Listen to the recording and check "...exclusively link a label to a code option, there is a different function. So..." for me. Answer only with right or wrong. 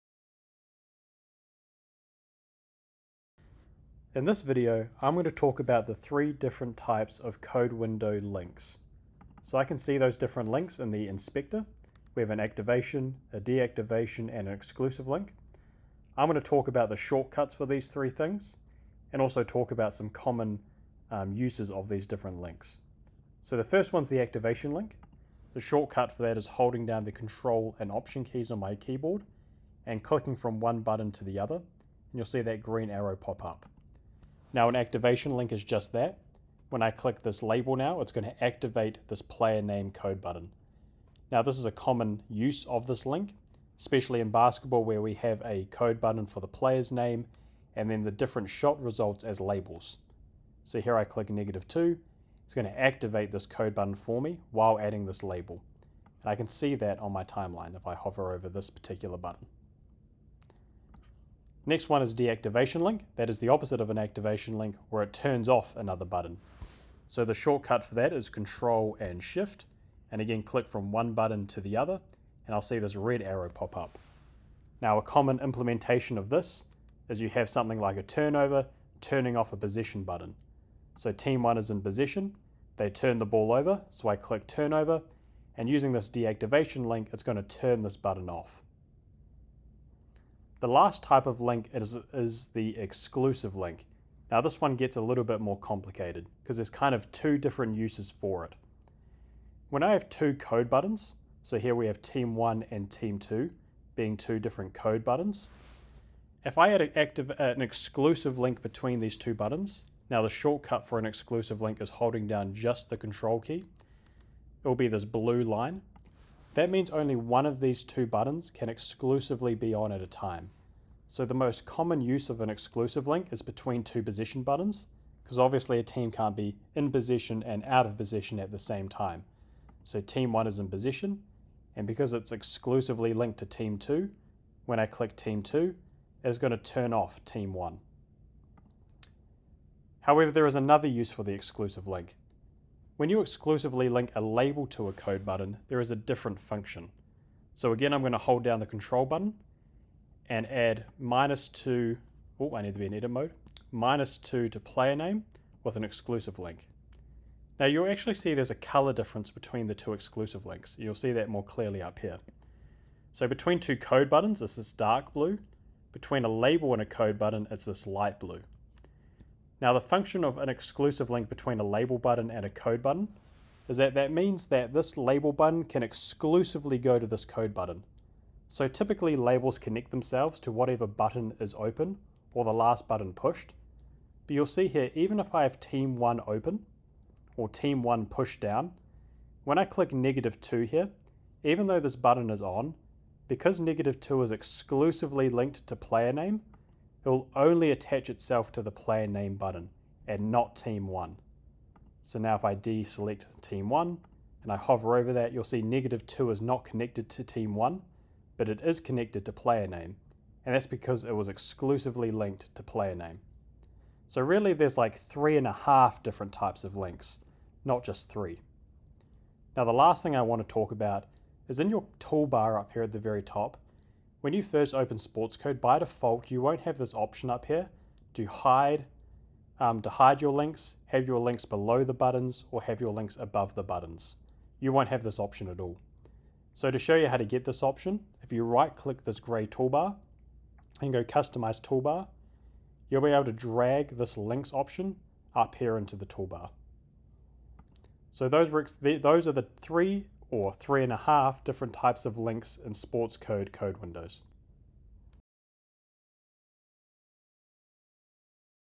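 wrong.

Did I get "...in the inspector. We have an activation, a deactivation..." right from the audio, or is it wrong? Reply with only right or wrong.
right.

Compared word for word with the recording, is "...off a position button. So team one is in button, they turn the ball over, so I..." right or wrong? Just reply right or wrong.
wrong.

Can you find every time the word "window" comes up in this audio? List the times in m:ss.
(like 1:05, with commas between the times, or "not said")
0:07, 4:13.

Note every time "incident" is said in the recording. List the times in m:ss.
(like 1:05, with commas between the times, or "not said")
not said.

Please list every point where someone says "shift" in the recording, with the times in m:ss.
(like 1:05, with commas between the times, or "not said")
1:09.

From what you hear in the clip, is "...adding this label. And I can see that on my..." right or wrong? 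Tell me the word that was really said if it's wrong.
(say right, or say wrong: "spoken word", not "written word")
right.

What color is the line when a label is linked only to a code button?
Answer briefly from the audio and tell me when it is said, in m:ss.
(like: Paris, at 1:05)
Light blue, at 2:47.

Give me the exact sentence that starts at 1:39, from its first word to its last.
When I have two code buttons, so here we have team one and team two being two different code buttons.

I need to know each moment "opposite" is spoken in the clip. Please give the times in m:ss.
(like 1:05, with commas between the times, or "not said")
1:03.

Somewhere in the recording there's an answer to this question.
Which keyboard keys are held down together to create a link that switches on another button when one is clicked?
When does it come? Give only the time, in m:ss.
0:27.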